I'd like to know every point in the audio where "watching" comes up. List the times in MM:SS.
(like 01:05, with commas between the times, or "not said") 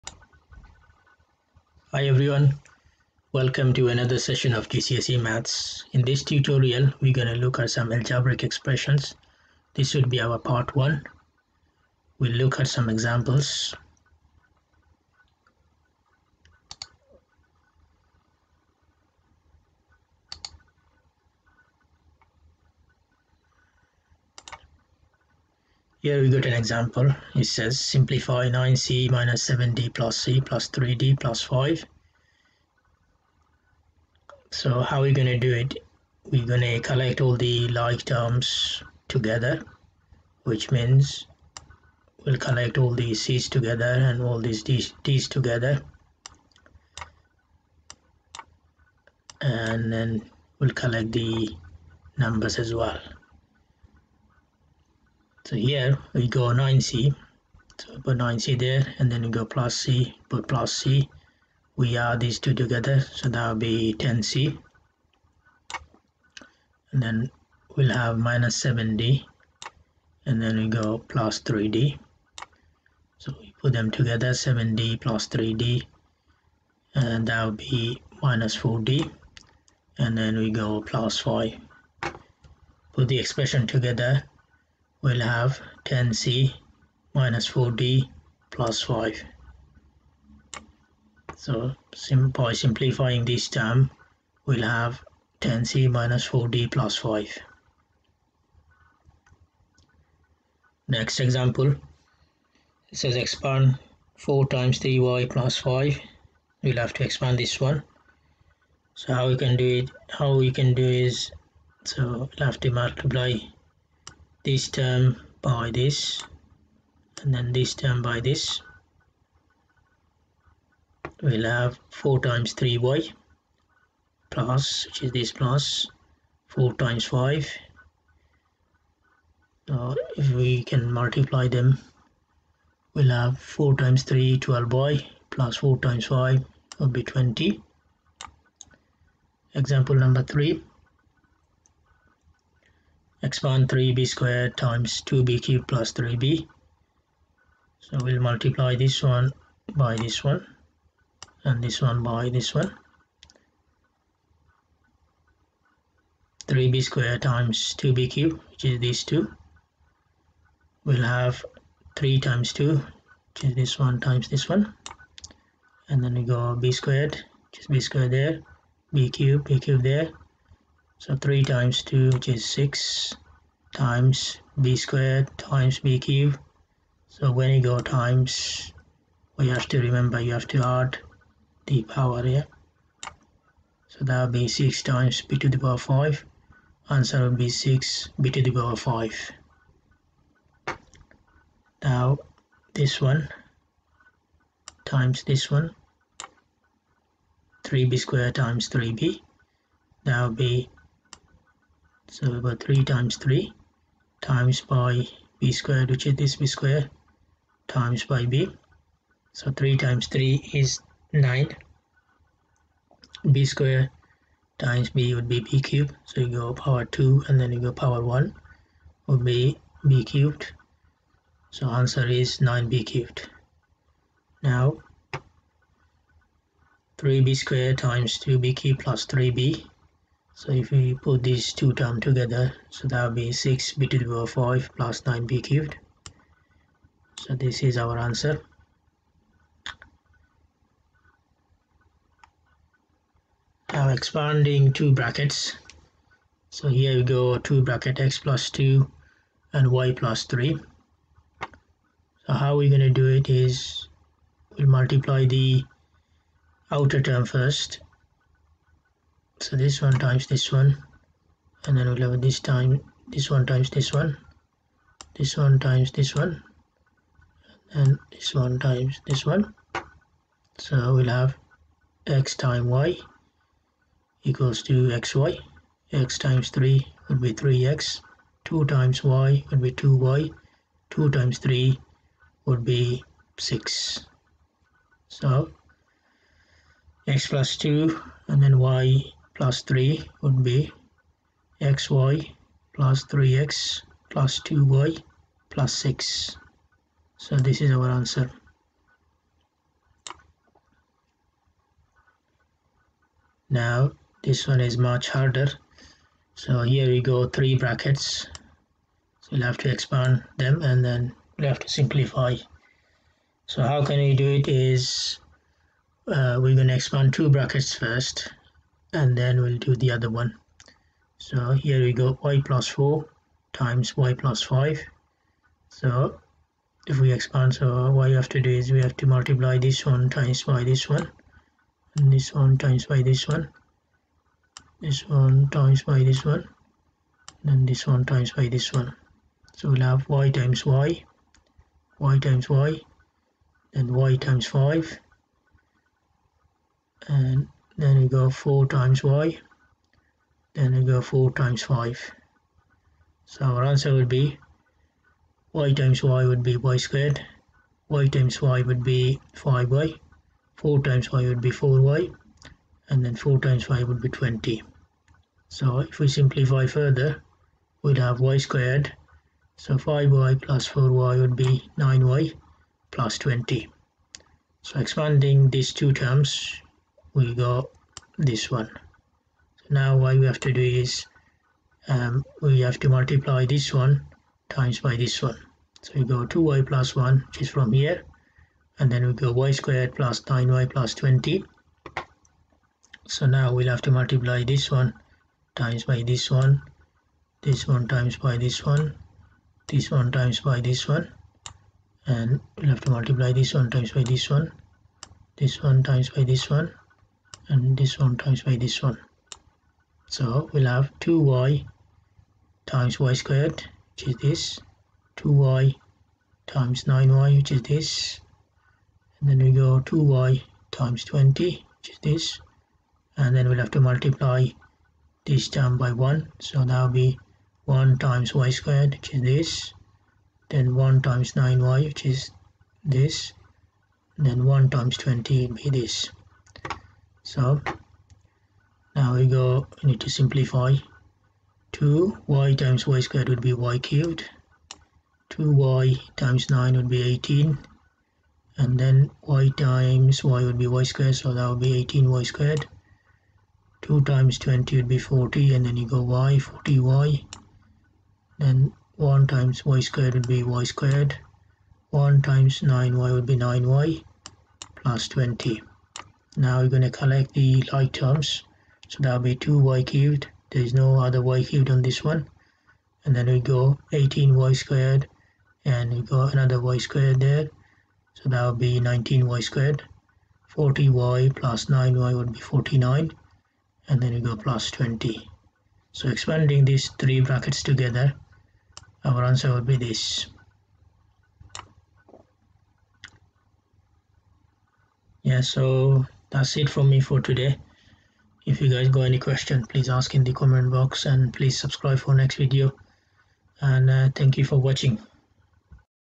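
08:24.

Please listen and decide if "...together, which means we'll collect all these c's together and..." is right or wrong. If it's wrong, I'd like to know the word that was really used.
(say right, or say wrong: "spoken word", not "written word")
right.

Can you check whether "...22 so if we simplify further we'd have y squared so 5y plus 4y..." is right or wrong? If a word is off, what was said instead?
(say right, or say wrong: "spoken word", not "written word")
wrong: "20", not "22".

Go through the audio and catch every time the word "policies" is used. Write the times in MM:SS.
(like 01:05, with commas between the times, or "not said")
not said.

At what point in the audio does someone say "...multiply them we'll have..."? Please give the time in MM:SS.
02:10.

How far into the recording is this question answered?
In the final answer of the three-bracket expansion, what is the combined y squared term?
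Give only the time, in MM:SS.
07:58.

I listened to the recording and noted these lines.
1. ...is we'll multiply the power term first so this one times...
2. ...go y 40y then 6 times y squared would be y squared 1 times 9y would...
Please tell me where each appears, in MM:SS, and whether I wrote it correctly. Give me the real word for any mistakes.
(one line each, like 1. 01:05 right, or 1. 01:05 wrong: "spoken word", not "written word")
1. 04:13 wrong: "outer", not "power"
2. 07:35 wrong: "1", not "6".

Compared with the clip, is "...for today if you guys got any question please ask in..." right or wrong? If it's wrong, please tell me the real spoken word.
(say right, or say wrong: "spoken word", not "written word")
right.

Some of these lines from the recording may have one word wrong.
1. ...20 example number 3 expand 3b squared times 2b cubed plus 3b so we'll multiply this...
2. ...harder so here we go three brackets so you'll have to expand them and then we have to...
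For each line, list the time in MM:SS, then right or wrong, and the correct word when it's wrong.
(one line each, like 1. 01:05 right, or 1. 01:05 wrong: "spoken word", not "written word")
1. 02:17 right
2. 05:05 right.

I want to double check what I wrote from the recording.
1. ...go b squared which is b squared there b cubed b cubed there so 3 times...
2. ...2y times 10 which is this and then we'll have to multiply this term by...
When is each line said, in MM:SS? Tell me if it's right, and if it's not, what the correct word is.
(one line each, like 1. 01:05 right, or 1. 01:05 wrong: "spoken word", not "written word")
1. 02:46 right
2. 06:59 wrong: "20", not "10".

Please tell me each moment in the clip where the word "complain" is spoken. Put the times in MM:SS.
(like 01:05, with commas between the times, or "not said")
not said.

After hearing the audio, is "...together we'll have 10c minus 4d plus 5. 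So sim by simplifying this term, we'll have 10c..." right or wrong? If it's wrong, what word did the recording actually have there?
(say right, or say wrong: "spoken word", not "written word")
right.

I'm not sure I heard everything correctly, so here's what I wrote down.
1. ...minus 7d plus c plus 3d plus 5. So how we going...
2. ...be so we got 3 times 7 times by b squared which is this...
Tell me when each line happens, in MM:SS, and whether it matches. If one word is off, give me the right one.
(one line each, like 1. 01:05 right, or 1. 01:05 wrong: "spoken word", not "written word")
1. 00:29 right
2. 03:20 wrong: "3", not "7".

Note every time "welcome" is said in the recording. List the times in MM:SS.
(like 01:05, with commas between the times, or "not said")
00:03.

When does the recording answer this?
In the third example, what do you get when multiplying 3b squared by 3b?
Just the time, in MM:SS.
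03:42.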